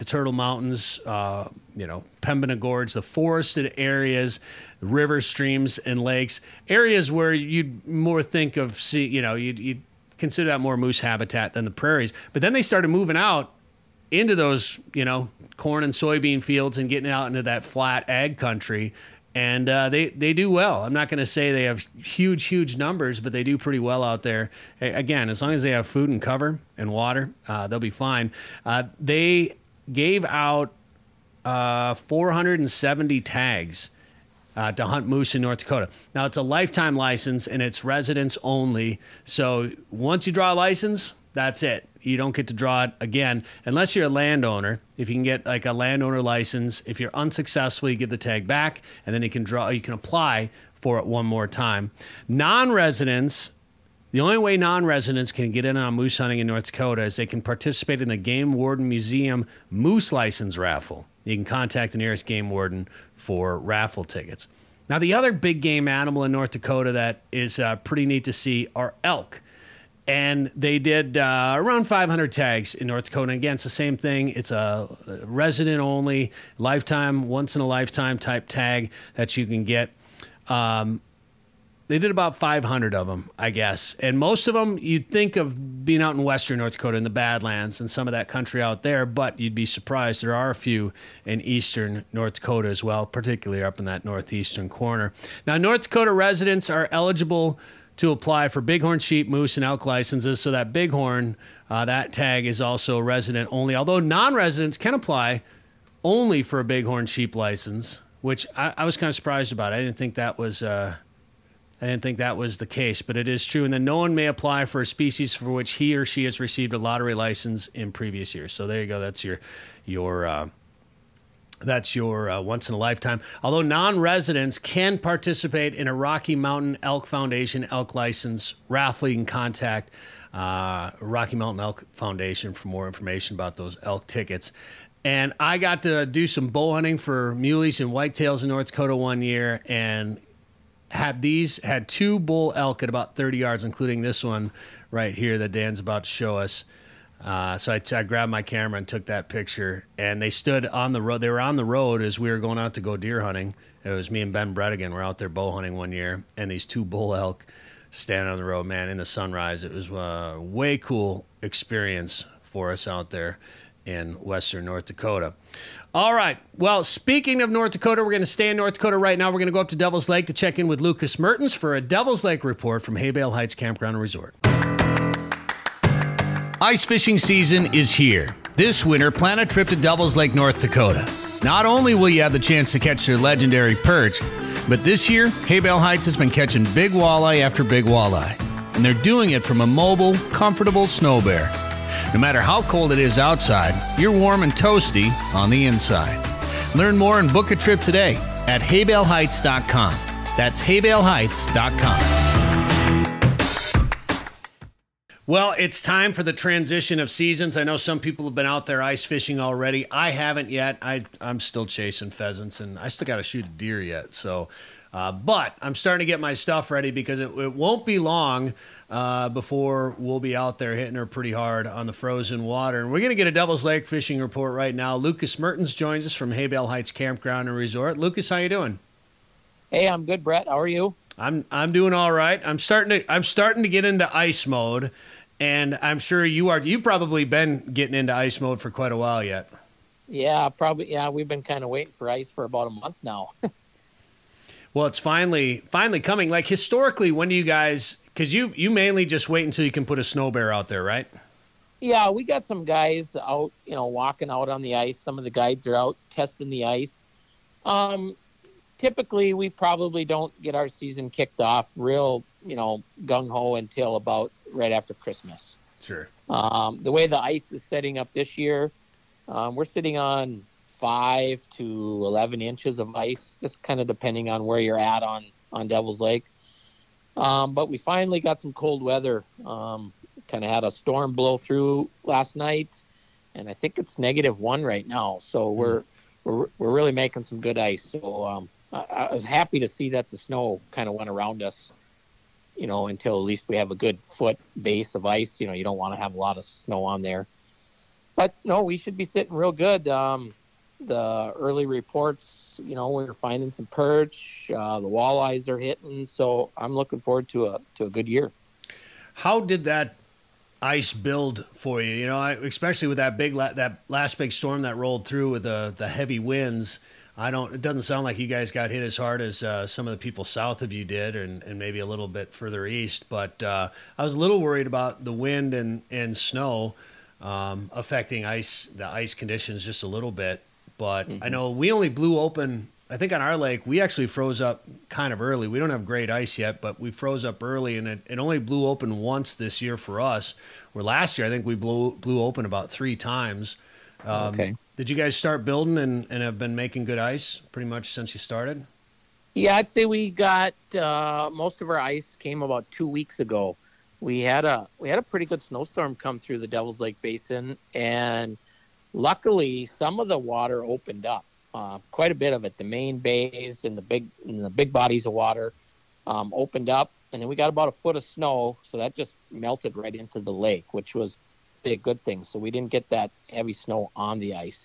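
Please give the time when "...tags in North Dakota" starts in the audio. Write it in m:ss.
1:12.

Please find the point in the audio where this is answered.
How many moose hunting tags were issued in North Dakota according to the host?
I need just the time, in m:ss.
0:31.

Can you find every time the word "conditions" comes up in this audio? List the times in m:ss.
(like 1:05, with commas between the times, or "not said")
5:29.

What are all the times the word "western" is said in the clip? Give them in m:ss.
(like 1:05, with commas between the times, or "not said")
1:26, 2:44.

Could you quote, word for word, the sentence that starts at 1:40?
So that bighorn, uh, that tag is also resident only.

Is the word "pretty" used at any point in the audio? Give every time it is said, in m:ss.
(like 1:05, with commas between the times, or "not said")
0:23, 1:07, 3:41, 5:47, 5:55.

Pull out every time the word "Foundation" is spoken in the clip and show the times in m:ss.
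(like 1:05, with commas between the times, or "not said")
2:07, 2:11.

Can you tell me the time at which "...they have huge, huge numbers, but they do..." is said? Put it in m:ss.
0:21.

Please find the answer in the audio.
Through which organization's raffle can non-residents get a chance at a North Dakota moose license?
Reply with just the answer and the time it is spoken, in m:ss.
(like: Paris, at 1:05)
Game Warden Museum, at 0:58.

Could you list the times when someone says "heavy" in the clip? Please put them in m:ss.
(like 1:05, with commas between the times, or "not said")
5:15, 6:13.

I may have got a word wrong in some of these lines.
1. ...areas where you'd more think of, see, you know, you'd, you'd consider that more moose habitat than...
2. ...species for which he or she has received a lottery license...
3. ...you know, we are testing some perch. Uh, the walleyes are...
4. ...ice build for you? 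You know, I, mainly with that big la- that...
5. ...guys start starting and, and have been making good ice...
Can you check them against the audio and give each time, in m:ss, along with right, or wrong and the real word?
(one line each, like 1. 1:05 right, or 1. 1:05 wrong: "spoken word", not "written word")
1. 0:06 right
2. 1:54 right
3. 5:02 wrong: "finding", not "testing"
4. 5:10 wrong: "especially", not "mainly"
5. 5:44 wrong: "building", not "starting".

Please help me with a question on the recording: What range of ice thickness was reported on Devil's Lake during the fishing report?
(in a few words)
5 to 11 inches.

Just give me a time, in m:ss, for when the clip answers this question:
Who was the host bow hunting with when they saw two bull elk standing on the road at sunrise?
2:34.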